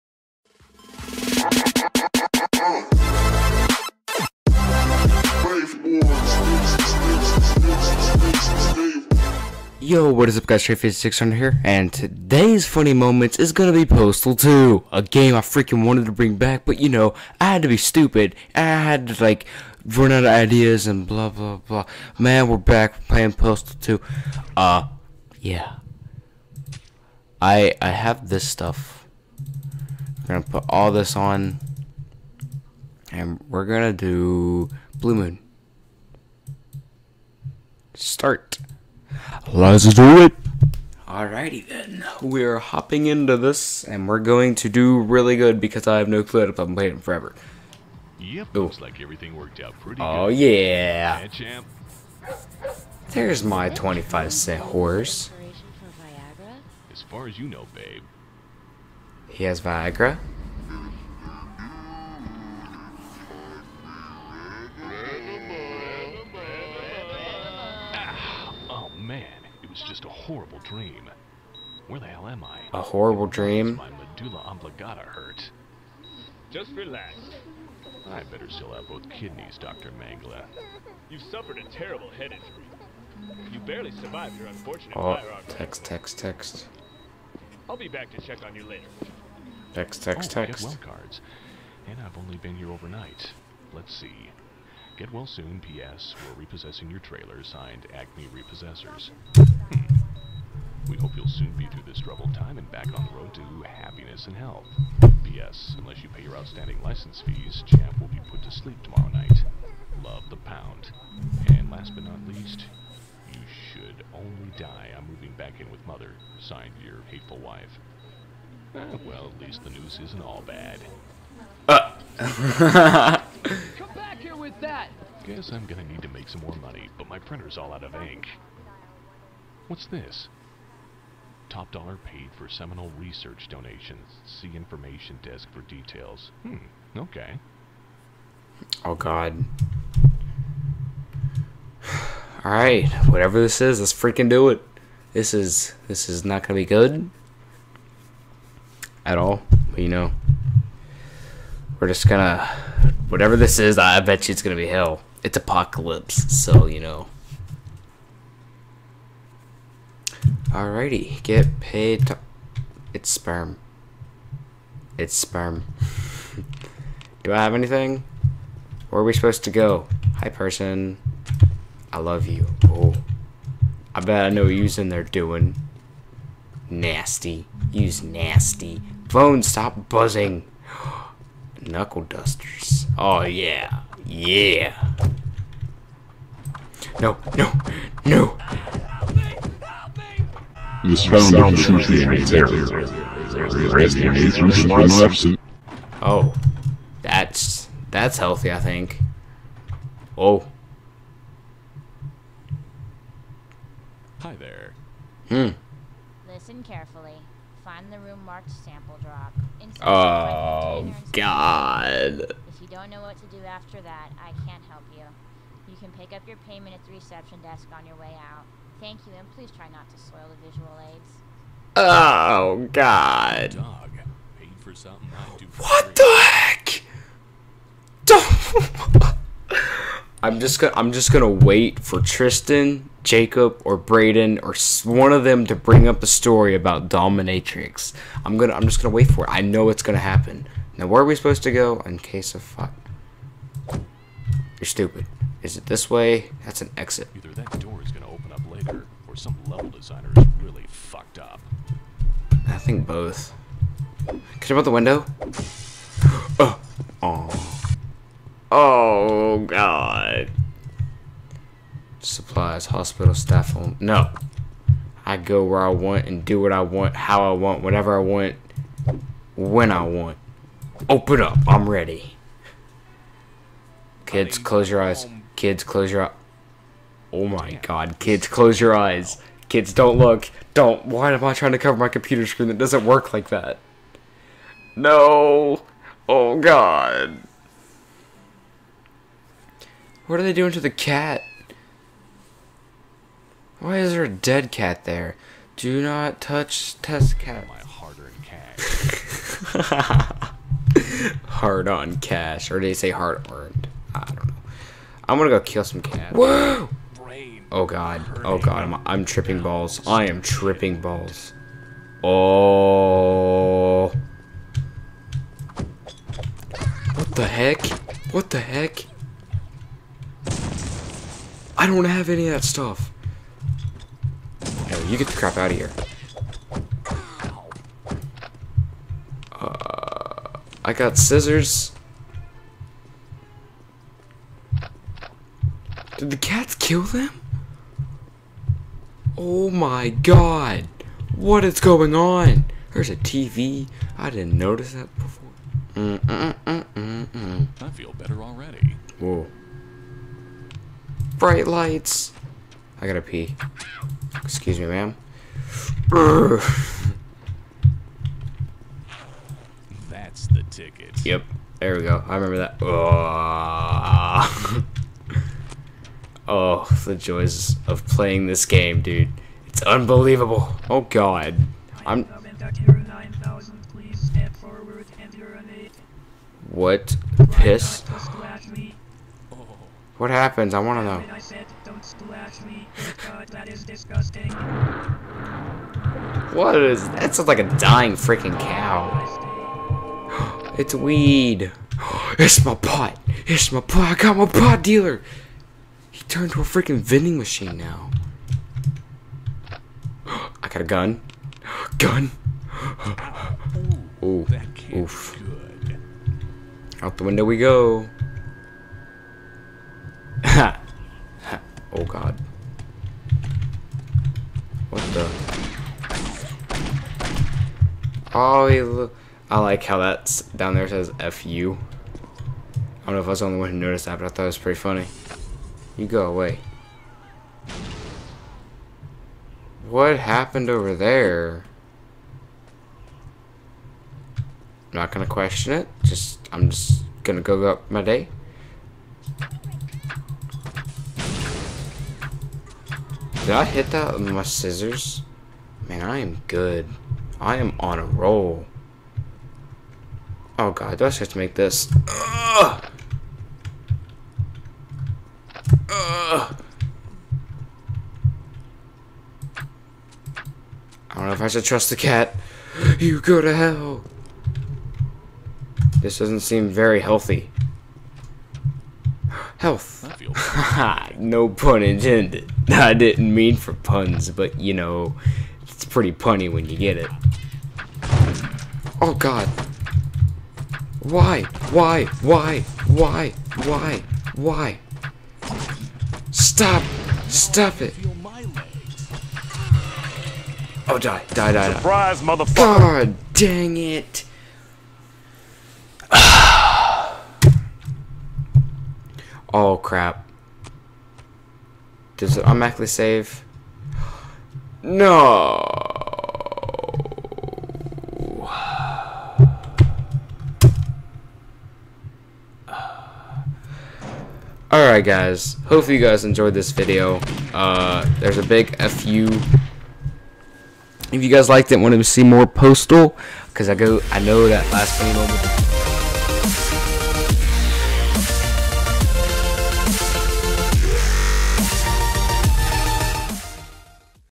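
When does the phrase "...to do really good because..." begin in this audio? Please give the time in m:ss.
0:44.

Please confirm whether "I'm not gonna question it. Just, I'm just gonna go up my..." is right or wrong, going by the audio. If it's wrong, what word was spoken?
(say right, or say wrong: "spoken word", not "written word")
right.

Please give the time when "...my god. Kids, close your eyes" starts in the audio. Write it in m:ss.
4:37.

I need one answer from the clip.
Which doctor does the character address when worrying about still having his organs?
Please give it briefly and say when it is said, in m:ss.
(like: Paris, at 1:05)
Dr. Mangla, at 1:19.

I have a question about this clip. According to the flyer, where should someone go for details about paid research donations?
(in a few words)
information desk.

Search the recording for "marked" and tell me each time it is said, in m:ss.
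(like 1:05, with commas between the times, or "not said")
3:28.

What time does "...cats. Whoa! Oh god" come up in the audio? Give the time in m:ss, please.
5:05.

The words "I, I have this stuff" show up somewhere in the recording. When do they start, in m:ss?
0:27.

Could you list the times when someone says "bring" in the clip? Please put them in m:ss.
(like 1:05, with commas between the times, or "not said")
0:16, 3:55.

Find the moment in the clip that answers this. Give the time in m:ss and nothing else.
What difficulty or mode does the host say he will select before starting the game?
0:34.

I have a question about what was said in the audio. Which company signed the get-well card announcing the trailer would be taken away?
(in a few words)
Acme Repossessors.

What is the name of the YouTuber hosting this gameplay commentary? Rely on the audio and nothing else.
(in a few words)
Trae600.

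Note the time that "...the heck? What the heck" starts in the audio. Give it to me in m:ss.
5:17.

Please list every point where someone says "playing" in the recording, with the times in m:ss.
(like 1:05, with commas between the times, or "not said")
0:23, 0:46, 6:07.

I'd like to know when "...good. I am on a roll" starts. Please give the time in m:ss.
7:26.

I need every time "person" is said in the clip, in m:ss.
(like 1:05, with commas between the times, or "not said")
2:50.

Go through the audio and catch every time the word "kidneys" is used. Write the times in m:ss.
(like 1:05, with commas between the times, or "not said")
1:19.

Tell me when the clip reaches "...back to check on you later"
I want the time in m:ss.
1:27.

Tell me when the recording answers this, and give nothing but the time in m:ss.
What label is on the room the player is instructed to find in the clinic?
3:28.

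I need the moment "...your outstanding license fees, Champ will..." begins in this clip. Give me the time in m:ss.
1:46.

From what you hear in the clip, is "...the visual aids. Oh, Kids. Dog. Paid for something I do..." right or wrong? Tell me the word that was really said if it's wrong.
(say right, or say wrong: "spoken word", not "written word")
wrong: "God", not "Kids".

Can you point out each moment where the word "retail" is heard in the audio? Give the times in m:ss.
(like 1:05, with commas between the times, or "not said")
not said.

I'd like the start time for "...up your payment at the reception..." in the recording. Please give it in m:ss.
3:36.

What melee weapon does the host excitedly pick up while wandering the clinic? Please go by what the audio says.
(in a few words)
Knuckle dusters.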